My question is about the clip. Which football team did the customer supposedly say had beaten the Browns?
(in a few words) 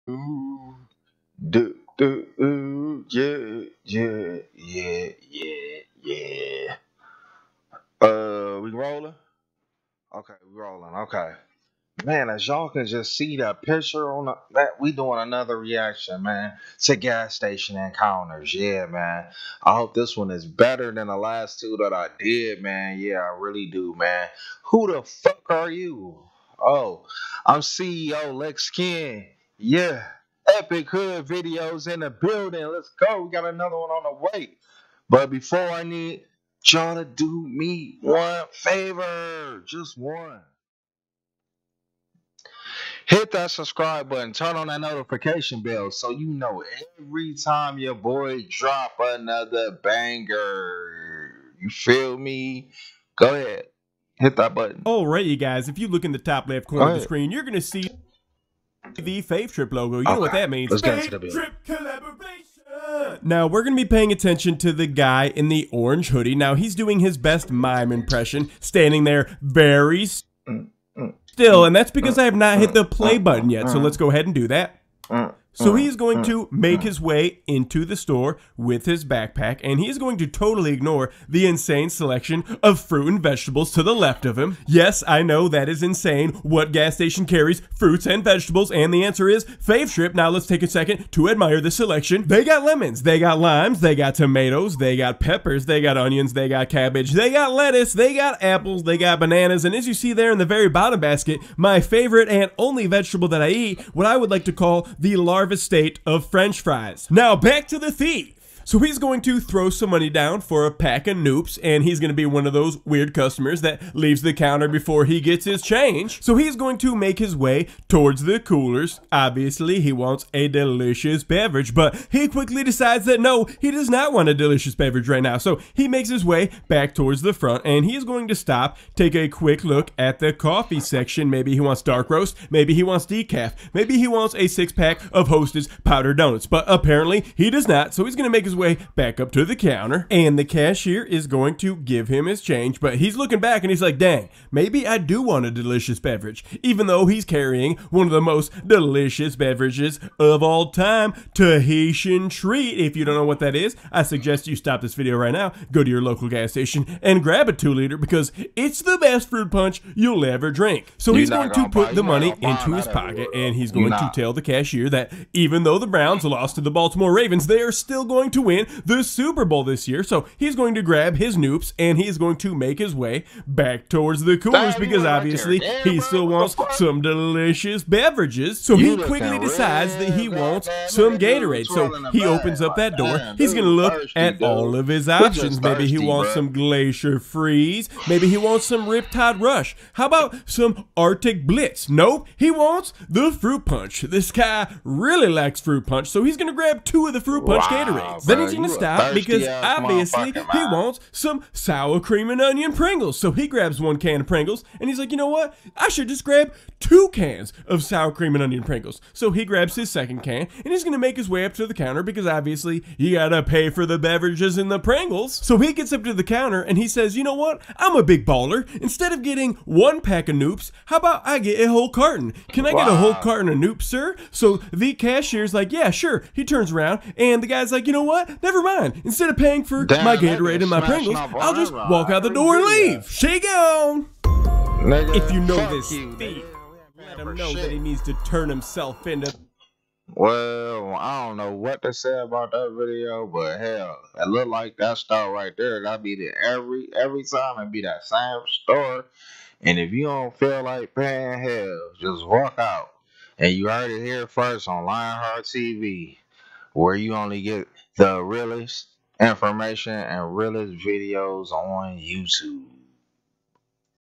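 Baltimore Ravens.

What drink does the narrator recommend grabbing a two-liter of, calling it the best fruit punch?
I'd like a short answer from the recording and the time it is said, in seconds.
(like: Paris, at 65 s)
Tahitian Treat, at 151 s.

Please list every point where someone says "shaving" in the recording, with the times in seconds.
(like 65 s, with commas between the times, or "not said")
not said.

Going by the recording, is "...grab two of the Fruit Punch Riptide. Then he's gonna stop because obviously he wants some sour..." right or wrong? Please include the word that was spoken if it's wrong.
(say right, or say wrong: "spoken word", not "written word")
wrong: "Gatorades", not "Riptide".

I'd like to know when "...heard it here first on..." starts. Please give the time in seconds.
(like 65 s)
253 s.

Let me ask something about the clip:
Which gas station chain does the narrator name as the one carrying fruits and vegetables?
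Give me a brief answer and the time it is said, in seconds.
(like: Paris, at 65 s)
Fave Trip, at 89 s.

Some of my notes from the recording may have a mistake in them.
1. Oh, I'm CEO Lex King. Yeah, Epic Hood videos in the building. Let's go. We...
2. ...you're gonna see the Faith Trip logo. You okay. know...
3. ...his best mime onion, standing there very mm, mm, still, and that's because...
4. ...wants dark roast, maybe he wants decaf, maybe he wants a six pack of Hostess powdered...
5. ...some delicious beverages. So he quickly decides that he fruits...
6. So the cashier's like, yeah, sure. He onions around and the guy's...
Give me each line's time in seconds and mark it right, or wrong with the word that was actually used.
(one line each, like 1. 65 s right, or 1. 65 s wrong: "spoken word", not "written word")
1. 26 s right
2. 57 s right
3. 66 s wrong: "impression", not "onion"
4. 131 s right
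5. 176 s wrong: "wants", not "fruits"
6. 224 s wrong: "turns", not "onions".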